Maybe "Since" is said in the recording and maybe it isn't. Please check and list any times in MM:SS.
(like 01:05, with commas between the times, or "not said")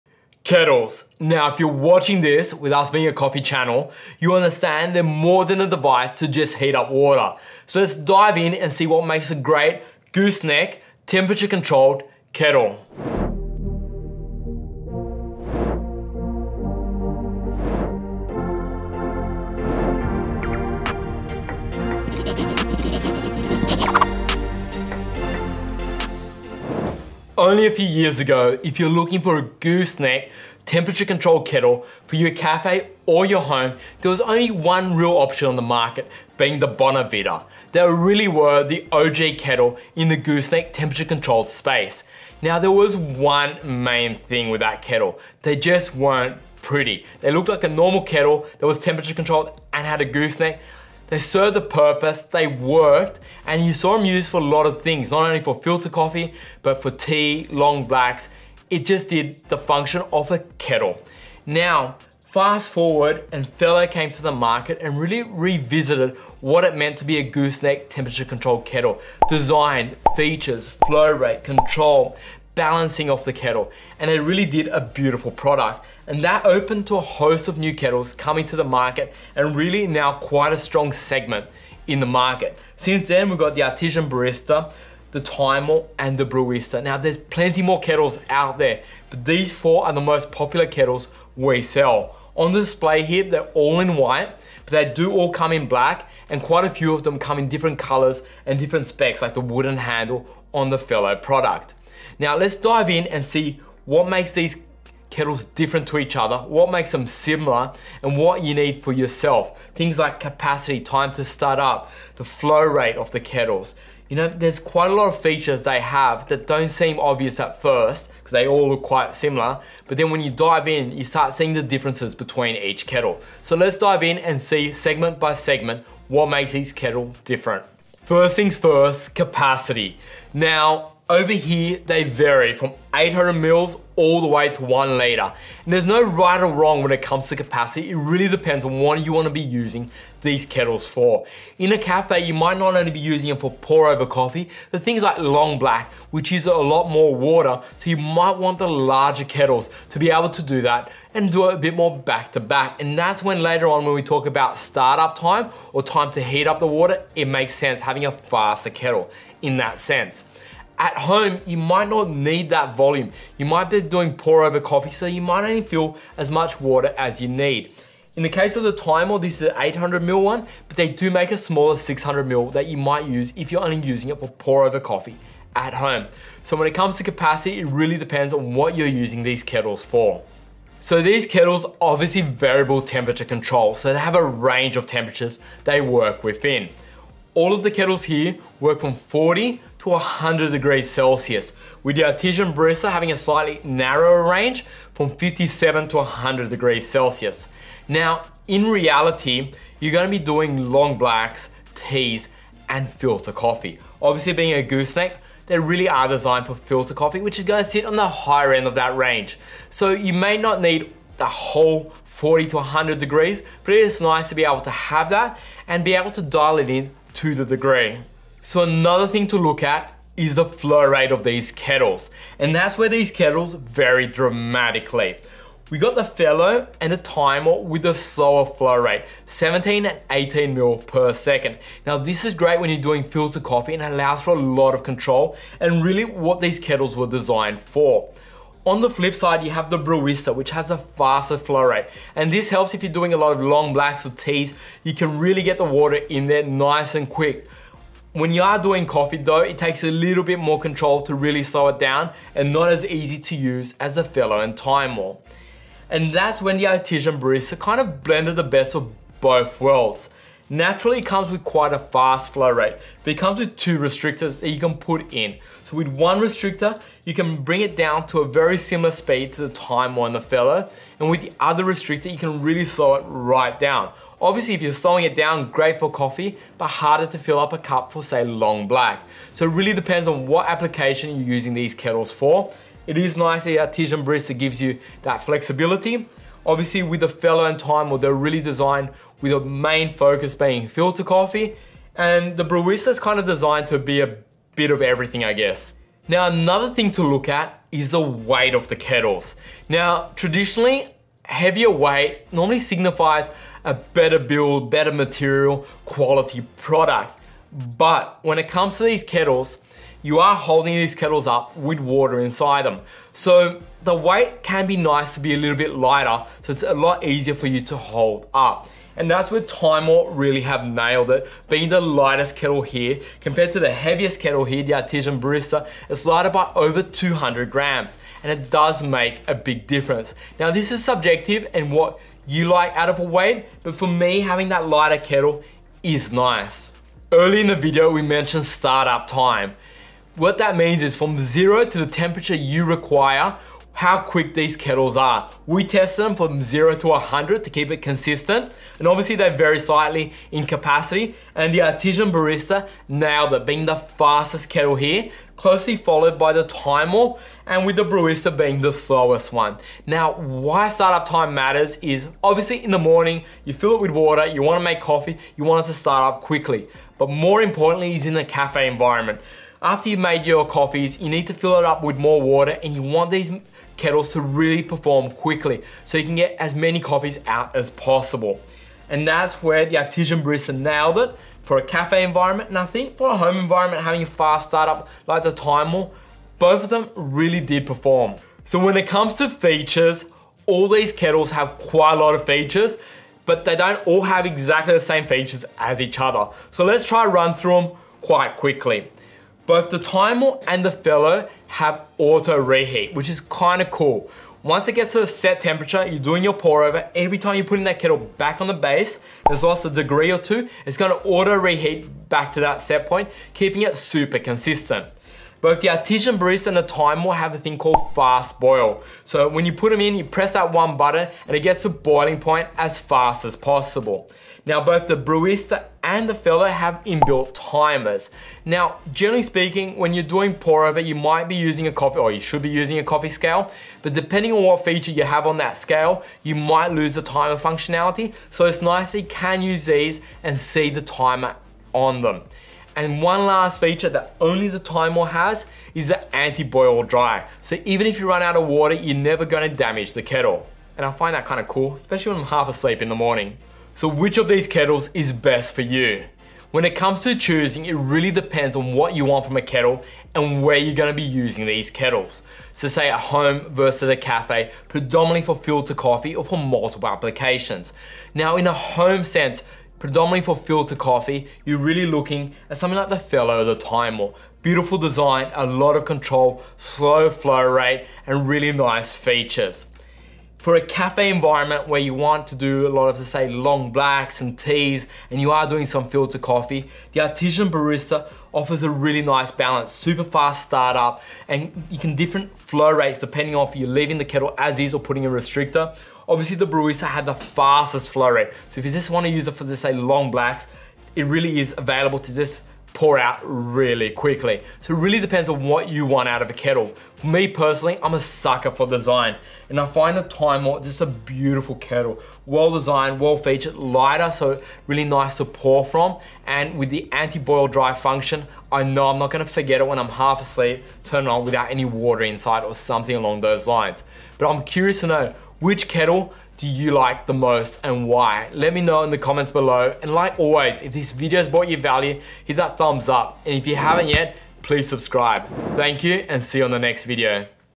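01:22.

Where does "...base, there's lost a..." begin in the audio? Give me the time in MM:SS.
06:48.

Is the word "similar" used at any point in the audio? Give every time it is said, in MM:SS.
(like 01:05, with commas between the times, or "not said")
01:47, 01:59, 04:28.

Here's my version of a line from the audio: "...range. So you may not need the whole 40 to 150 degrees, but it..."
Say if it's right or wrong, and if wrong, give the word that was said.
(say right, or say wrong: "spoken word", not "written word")
wrong: "100", not "150".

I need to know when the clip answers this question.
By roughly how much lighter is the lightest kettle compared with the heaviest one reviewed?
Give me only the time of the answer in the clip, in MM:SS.
05:26.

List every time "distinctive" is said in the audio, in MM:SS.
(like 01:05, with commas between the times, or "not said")
not said.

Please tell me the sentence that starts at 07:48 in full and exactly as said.
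Now in a home sense, predominantly for filter coffee, you're really looking at something like the Fellow, the Timemore.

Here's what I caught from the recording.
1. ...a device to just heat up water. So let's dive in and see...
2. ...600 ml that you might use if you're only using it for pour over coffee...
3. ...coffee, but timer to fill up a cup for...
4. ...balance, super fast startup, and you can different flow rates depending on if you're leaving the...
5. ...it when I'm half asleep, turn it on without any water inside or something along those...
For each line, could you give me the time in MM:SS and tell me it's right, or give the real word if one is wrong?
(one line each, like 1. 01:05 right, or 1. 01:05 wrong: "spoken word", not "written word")
1. 00:05 right
2. 02:51 right
3. 04:35 wrong: "harder", not "timer"
4. 08:09 right
5. 08:39 right.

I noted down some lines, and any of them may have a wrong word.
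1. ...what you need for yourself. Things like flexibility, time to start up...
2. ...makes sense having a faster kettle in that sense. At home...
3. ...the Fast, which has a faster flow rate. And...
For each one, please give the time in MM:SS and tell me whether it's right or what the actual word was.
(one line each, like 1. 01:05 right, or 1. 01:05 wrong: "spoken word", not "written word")
1. 01:48 wrong: "capacity", not "flexibility"
2. 02:37 right
3. 03:59 wrong: "Brewista", not "Fast".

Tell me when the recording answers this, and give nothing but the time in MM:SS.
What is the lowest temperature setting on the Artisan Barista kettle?
03:15.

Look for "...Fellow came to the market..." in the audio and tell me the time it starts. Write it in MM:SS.
01:03.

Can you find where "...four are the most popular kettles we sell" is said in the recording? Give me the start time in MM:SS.
01:29.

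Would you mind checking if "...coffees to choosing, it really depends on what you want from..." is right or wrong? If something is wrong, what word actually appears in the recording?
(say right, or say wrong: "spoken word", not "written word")
wrong: "comes", not "coffees".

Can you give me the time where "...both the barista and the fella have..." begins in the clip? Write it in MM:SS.
07:04.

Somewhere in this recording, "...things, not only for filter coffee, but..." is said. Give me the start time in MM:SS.
00:54.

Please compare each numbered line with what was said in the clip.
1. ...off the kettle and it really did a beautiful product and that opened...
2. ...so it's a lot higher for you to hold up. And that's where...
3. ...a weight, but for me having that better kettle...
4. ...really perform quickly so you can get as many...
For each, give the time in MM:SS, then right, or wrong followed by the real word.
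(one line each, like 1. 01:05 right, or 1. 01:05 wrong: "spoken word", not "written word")
1. 01:13 right
2. 05:16 wrong: "easier", not "higher"
3. 05:32 wrong: "lighter", not "better"
4. 06:14 right.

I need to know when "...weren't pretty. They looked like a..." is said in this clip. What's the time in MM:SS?
00:45.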